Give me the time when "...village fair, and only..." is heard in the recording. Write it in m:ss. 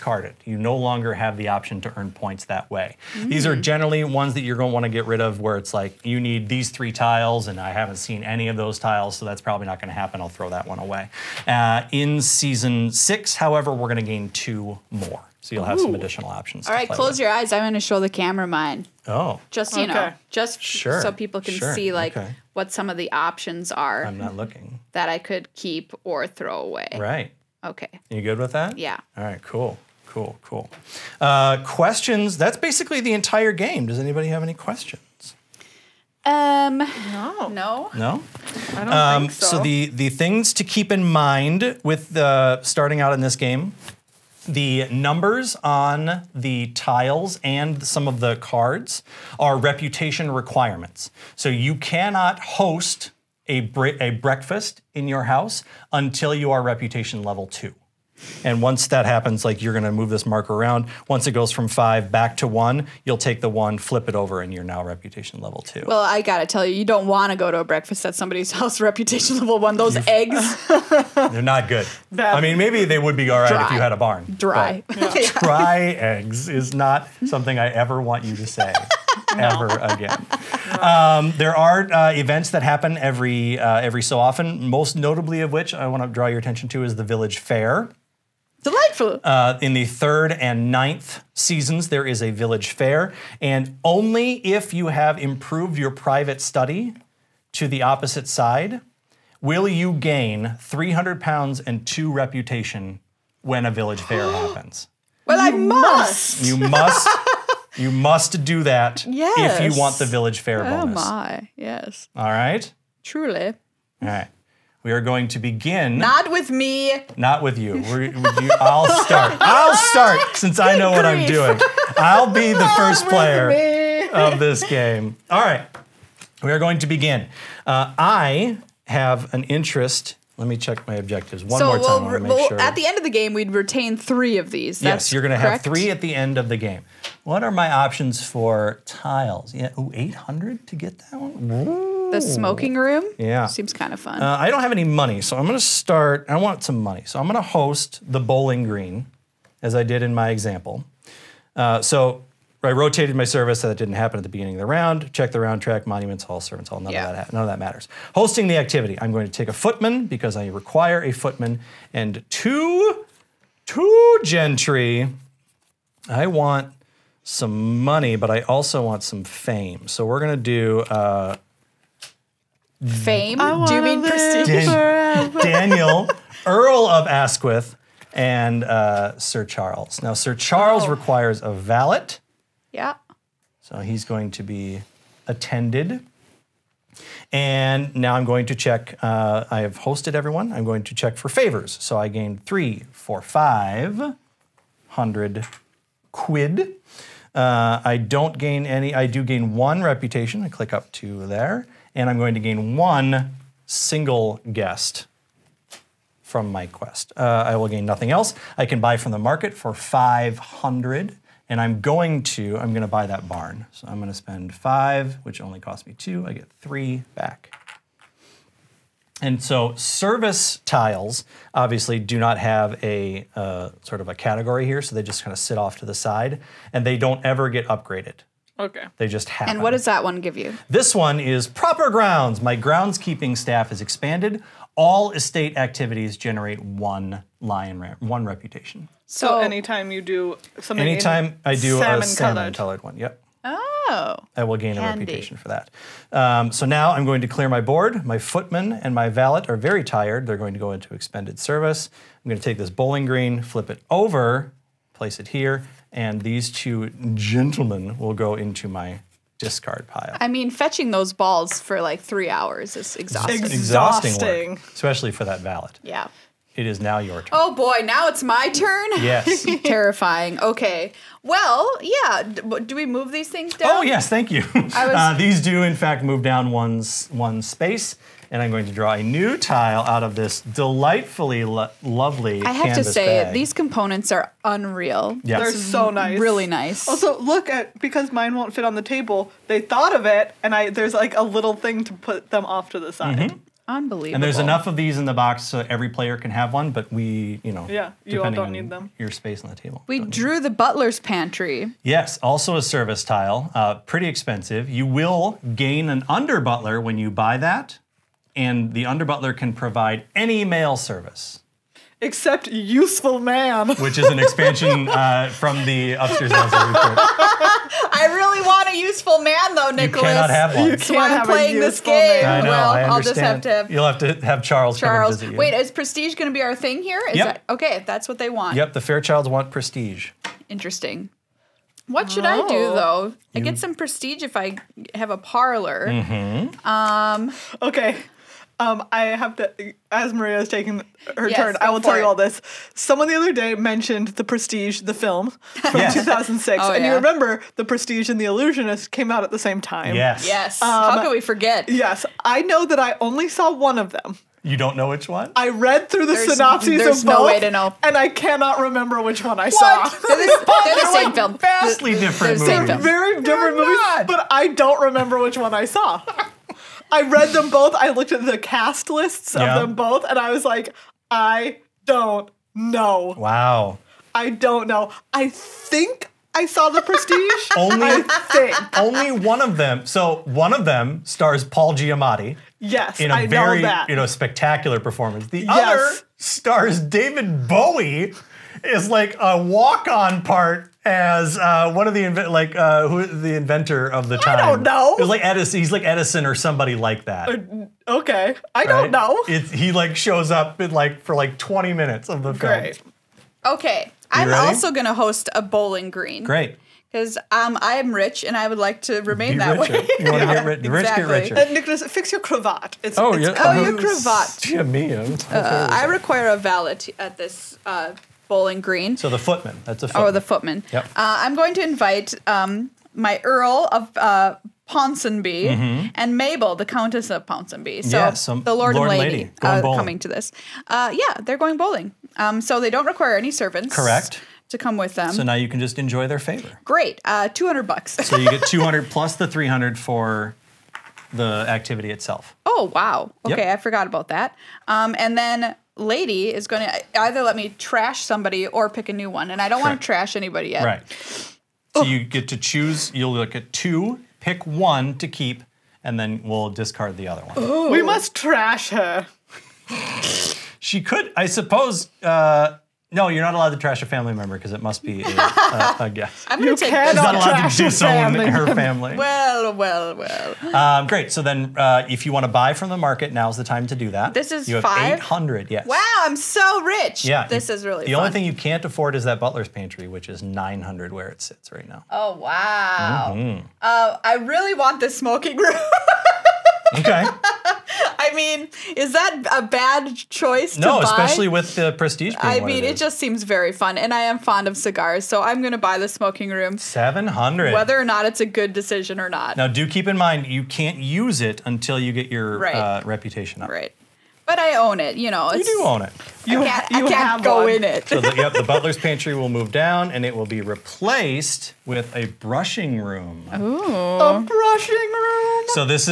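1:32.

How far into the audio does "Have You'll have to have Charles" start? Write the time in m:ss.
5:23.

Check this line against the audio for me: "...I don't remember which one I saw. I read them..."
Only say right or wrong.
right.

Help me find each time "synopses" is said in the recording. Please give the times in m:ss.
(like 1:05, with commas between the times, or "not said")
5:56.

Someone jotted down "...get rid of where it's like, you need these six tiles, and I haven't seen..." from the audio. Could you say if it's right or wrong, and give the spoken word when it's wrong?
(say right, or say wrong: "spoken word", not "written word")
wrong: "three", not "six".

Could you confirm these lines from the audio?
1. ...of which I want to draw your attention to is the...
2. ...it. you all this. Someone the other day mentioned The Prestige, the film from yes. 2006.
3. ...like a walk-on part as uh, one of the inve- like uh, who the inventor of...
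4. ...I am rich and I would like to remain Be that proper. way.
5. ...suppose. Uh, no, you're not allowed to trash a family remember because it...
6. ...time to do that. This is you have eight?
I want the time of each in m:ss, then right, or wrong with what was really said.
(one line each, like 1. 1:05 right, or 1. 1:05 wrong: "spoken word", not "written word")
1. 1:25 right
2. 5:41 right
3. 6:28 right
4. 6:47 wrong: "richer", not "proper"
5. 7:41 wrong: "member", not "remember"
6. 7:53 wrong: "five", not "eight".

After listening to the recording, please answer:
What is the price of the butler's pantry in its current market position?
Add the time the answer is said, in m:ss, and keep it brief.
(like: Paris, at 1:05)
900, at 8:00.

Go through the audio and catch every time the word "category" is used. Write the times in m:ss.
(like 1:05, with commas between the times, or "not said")
3:44.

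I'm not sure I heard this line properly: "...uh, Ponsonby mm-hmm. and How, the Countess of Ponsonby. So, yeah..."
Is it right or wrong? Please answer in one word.
wrong.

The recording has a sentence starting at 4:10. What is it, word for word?
They're going to go into expended service.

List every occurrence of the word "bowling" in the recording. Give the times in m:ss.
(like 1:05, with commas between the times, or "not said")
2:28, 4:12, 6:45, 6:58, 7:11.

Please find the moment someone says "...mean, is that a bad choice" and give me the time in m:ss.
8:08.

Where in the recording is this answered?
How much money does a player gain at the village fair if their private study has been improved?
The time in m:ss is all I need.
1:40.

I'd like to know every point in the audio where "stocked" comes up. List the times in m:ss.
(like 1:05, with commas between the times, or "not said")
not said.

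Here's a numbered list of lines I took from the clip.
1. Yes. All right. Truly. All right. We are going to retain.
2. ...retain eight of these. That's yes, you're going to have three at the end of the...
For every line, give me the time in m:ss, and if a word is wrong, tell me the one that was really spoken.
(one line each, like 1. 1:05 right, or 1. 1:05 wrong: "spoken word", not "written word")
1. 1:51 wrong: "begin", not "retain"
2. 2:13 wrong: "three", not "eight".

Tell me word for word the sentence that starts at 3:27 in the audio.
Uh, I will gain nothing else.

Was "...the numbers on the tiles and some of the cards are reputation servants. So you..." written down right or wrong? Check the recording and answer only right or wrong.
wrong.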